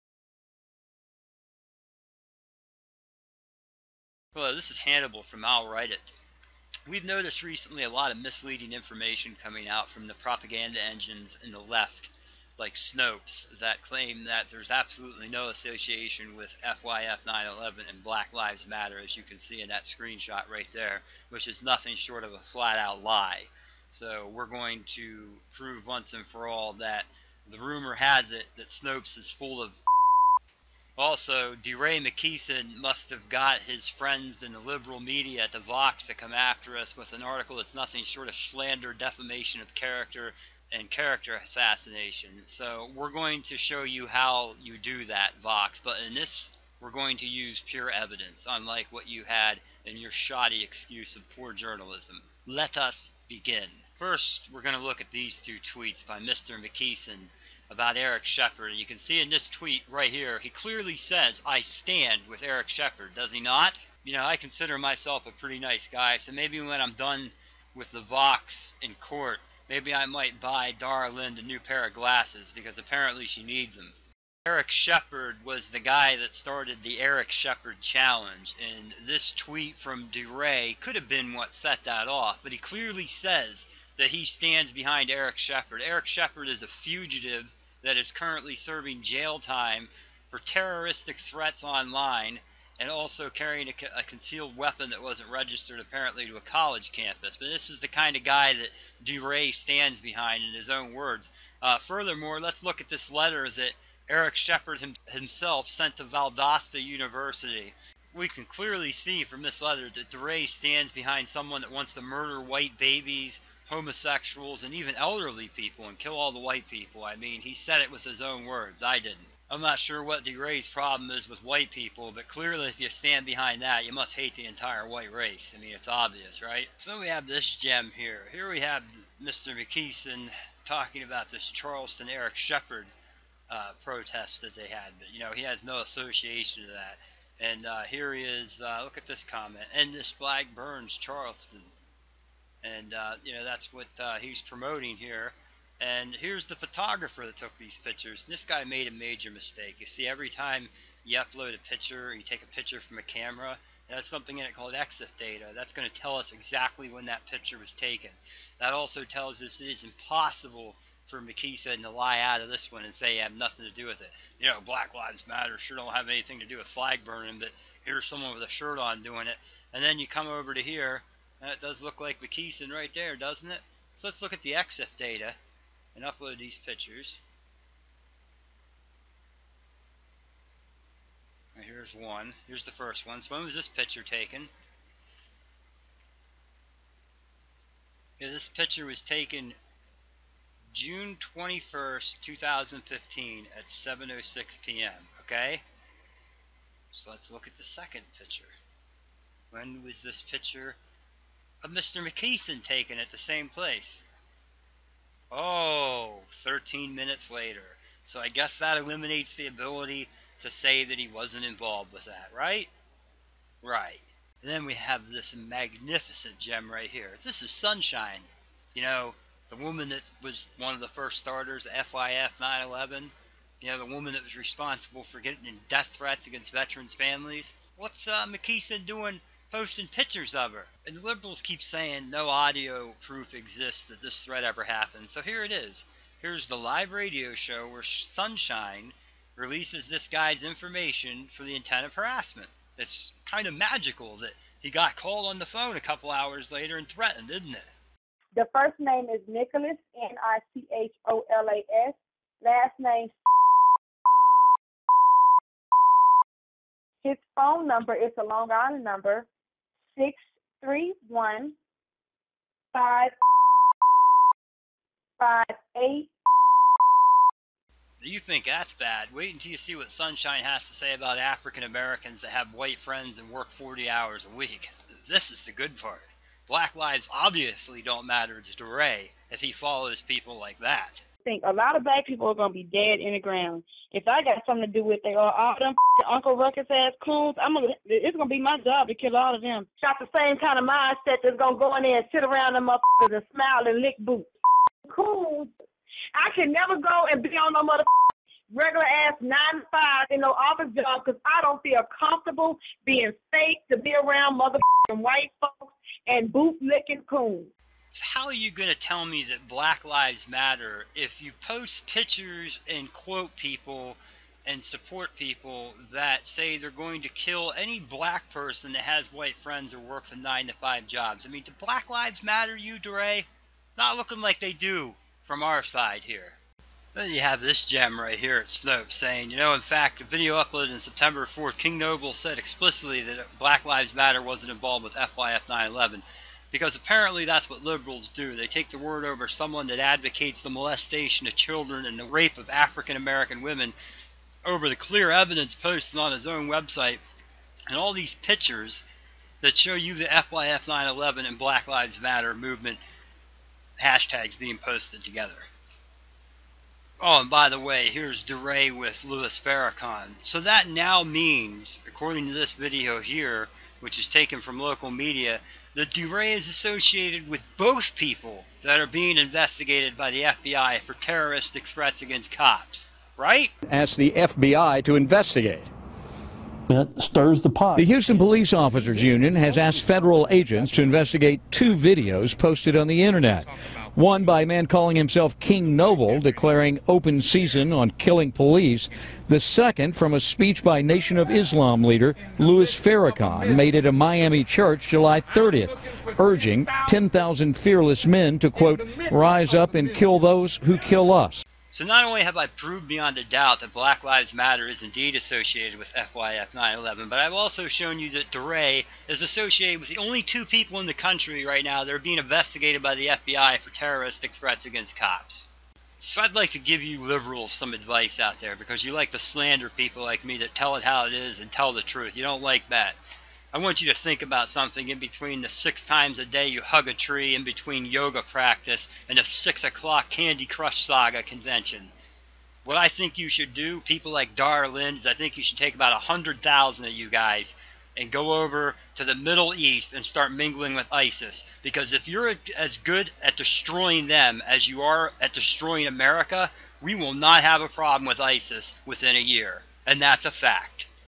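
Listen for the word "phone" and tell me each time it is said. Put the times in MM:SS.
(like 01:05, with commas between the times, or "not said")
04:05, 04:17.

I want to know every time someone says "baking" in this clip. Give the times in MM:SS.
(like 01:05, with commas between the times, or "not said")
not said.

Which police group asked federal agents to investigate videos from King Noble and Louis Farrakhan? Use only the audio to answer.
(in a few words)
Houston Police Officers Union.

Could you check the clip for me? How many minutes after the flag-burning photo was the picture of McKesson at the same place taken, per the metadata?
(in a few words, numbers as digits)
13 minutes.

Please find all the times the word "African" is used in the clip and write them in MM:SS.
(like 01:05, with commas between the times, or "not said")
04:31, 05:42.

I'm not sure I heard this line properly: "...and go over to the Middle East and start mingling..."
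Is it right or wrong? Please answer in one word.
right.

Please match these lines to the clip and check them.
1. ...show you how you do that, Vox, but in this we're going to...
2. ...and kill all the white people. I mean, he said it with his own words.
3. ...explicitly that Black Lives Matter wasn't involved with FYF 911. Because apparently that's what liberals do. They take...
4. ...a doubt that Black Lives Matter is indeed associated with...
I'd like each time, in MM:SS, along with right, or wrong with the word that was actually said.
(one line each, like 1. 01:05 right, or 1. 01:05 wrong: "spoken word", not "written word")
1. 00:43 right
2. 01:55 right
3. 05:32 right
4. 06:43 right.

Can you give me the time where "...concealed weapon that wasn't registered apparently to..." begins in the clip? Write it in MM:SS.
01:34.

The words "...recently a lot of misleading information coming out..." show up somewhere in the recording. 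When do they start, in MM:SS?
00:07.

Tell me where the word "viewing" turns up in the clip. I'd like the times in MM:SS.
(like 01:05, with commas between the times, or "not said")
not said.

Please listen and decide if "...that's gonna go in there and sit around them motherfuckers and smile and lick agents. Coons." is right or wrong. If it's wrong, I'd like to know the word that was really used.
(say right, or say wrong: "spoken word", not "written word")
wrong: "boots", not "agents".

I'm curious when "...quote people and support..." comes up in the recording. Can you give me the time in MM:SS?
05:12.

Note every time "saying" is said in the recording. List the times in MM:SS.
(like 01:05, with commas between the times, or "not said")
03:51, 05:28.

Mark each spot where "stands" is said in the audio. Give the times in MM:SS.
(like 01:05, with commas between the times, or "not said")
01:01, 01:24, 01:39, 01:50, 02:02.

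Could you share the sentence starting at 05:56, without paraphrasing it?
Oh, and by the way, here's DeRay with Louis Farrakhan.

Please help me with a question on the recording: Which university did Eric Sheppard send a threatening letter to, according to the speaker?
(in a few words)
Valdosta University.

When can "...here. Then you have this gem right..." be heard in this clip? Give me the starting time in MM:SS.
05:26.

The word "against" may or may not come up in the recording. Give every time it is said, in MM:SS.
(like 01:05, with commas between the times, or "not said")
03:46, 06:12, 06:54.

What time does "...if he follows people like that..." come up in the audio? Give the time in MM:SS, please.
04:39.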